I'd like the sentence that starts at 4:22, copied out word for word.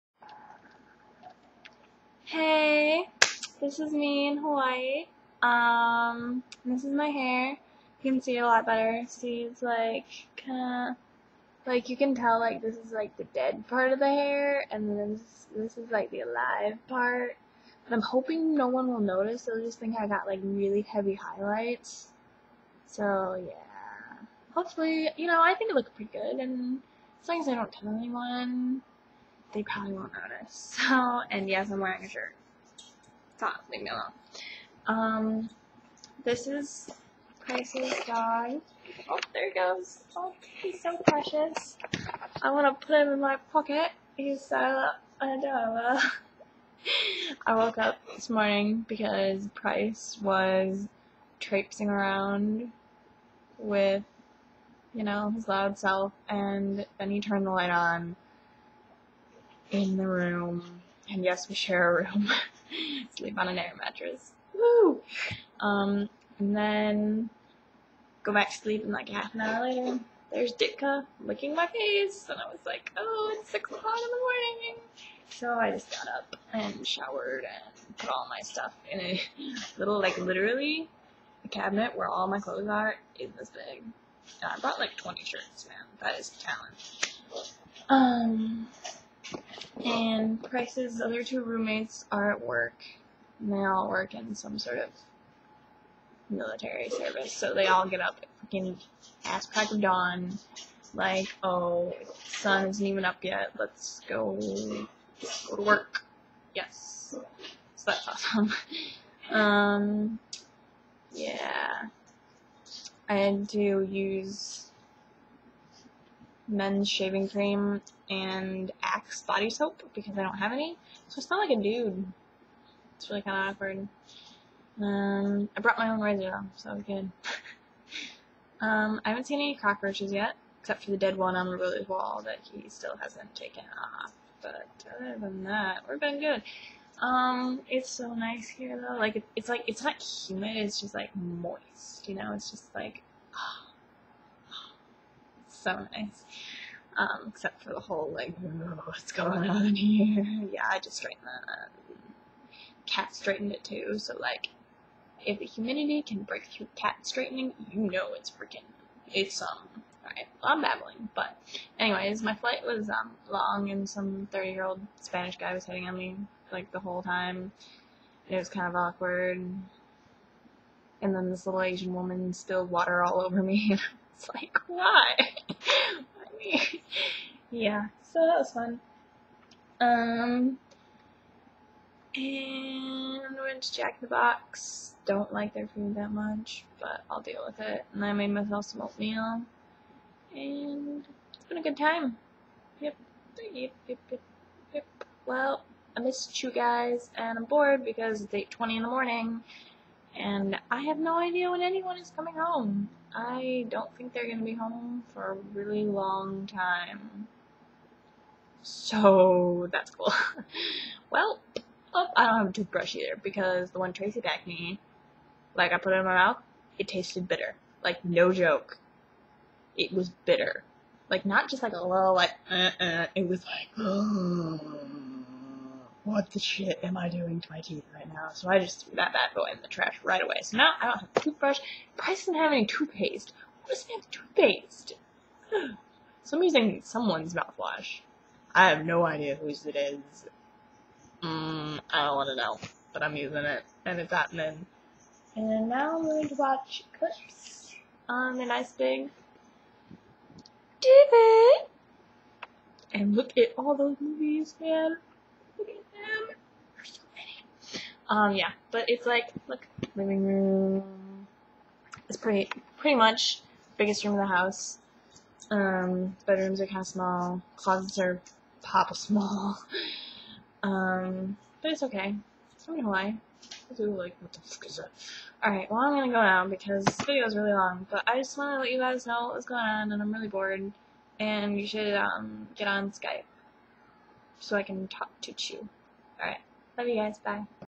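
It's pretty, pretty much biggest room in the house.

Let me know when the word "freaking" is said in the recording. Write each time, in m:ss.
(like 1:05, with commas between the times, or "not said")
1:38, 2:38.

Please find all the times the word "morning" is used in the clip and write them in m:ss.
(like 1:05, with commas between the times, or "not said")
0:48, 1:14, 3:18.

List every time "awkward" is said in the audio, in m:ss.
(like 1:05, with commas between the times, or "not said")
2:03, 2:48.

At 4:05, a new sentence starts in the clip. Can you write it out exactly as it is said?
And now I'm going to watch clips on a nice big TV.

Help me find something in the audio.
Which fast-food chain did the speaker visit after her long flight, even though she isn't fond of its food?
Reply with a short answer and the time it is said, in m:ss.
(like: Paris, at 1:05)
Jack in the Box, at 3:03.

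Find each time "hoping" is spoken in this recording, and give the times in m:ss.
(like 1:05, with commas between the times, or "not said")
0:18.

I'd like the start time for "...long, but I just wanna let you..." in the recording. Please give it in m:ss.
4:37.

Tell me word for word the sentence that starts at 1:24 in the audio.
And I brought like 20 shirts, man.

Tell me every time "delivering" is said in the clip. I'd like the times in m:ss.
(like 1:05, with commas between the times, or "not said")
not said.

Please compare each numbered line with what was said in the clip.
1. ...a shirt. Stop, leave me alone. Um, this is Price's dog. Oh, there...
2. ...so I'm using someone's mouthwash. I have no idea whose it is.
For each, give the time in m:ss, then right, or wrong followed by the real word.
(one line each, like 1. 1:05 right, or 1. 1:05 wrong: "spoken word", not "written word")
1. 0:32 right
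2. 3:56 right.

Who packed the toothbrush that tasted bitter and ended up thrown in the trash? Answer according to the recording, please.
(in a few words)
Tracy.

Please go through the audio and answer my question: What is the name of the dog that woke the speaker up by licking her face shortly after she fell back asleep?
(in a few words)
Ditka.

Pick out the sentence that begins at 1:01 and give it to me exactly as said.
And yes, we share a room.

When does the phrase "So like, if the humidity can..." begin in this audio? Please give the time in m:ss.
2:33.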